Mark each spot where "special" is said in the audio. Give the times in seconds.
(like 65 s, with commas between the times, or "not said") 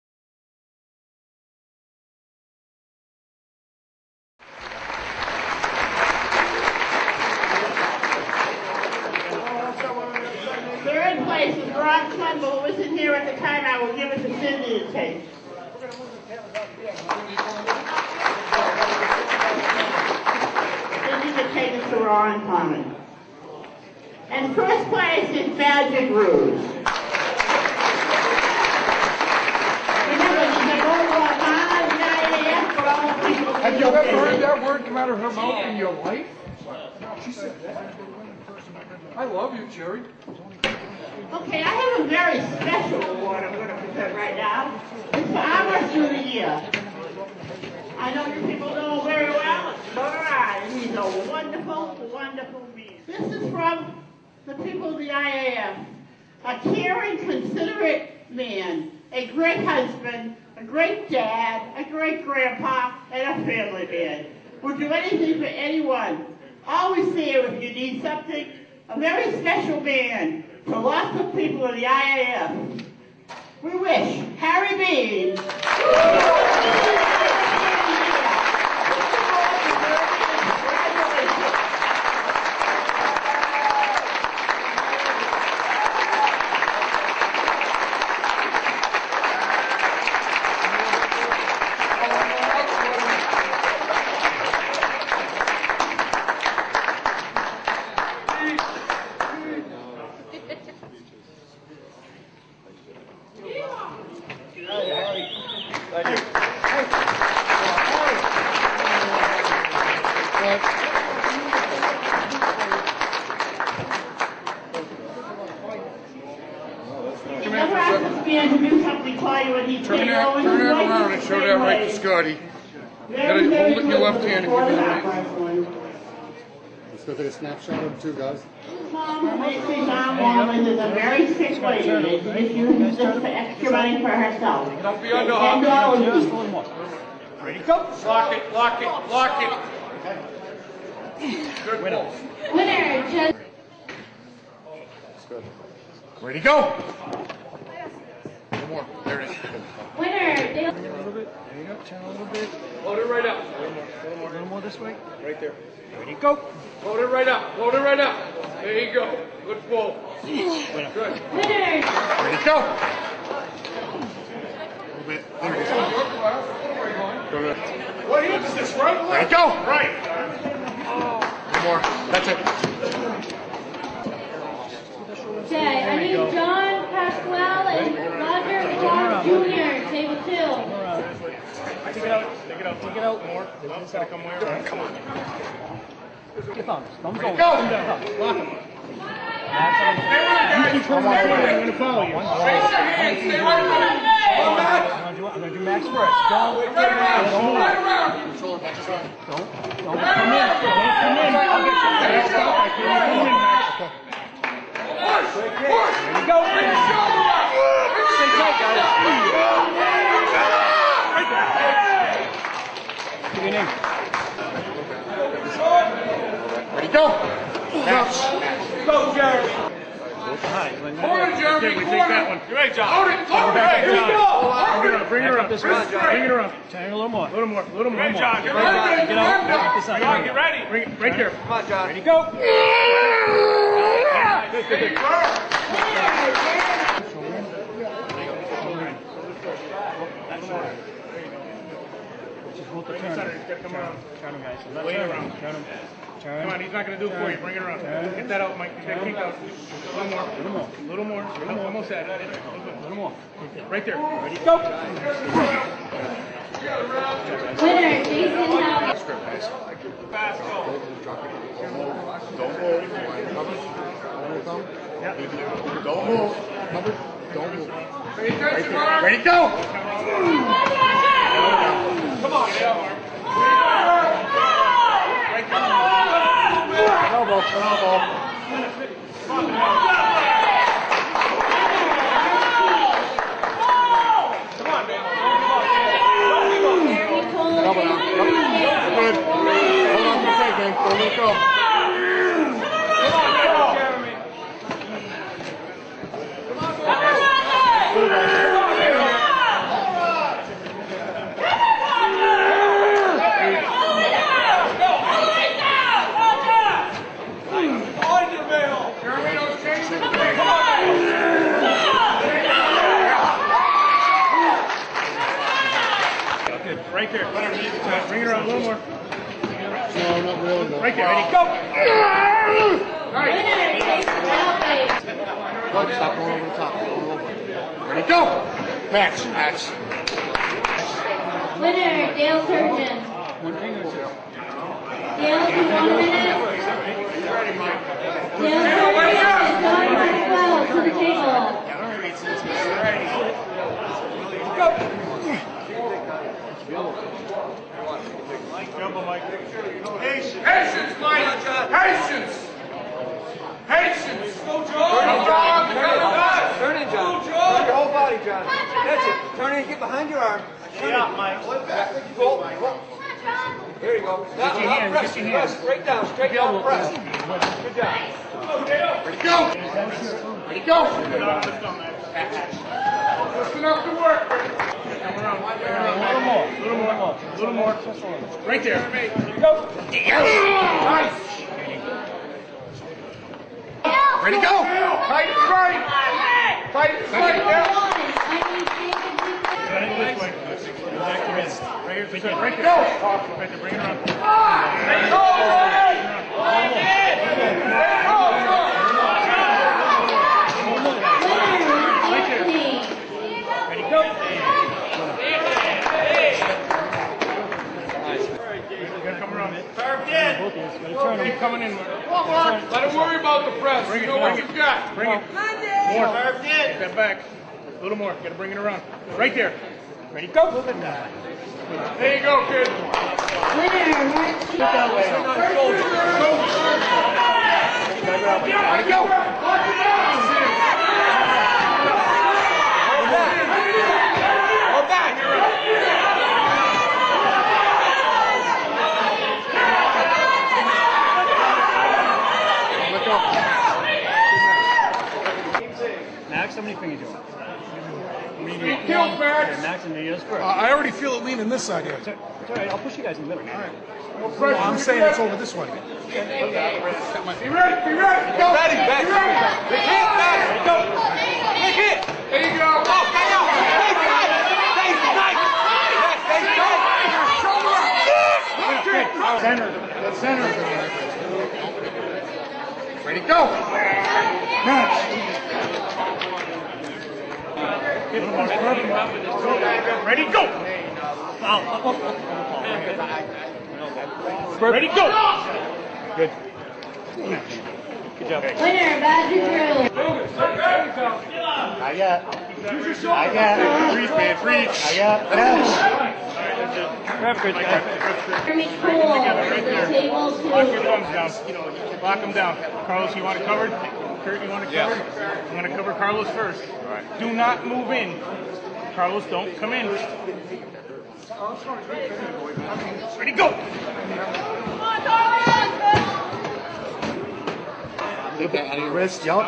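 42 s, 69 s.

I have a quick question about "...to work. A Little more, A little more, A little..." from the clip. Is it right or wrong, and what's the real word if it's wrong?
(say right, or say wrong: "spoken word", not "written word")
right.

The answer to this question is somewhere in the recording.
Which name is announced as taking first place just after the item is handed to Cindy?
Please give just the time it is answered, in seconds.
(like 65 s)
25 s.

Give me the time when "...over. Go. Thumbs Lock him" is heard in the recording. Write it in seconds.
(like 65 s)
187 s.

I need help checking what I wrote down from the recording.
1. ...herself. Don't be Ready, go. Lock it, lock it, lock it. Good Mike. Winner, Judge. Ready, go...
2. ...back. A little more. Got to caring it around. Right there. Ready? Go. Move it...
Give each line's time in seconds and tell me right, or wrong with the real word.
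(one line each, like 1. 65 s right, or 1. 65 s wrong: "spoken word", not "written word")
1. 134 s wrong: "Winner", not "Mike"
2. 416 s wrong: "bring", not "caring".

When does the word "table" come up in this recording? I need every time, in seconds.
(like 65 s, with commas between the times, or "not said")
340 s, 499 s.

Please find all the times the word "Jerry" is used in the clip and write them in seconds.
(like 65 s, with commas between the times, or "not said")
39 s, 219 s.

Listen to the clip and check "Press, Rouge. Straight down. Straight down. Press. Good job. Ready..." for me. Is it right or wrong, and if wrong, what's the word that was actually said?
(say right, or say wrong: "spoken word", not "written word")
wrong: "Press", not "Rouge".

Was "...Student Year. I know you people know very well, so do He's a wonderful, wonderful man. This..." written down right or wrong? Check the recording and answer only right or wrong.
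right.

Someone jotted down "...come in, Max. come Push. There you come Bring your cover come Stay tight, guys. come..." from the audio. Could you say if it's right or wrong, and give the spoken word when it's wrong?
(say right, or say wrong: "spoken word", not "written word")
wrong: "shoulder", not "cover".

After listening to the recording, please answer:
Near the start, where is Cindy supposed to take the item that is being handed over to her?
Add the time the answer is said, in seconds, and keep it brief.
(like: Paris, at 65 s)
Rowan Common, at 21 s.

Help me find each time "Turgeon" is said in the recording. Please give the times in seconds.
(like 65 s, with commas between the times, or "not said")
332 s, 338 s.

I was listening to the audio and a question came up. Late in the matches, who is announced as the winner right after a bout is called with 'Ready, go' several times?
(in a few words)
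Badger Drill.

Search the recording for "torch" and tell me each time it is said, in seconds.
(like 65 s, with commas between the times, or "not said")
not said.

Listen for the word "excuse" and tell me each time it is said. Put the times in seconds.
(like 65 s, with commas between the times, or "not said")
not said.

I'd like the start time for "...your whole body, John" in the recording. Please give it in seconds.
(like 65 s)
357 s.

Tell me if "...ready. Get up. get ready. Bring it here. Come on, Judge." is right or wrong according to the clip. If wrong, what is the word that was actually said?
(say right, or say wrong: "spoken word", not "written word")
wrong: "John", not "Judge".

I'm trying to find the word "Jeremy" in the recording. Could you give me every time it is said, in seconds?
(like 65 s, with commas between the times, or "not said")
221 s, 498 s.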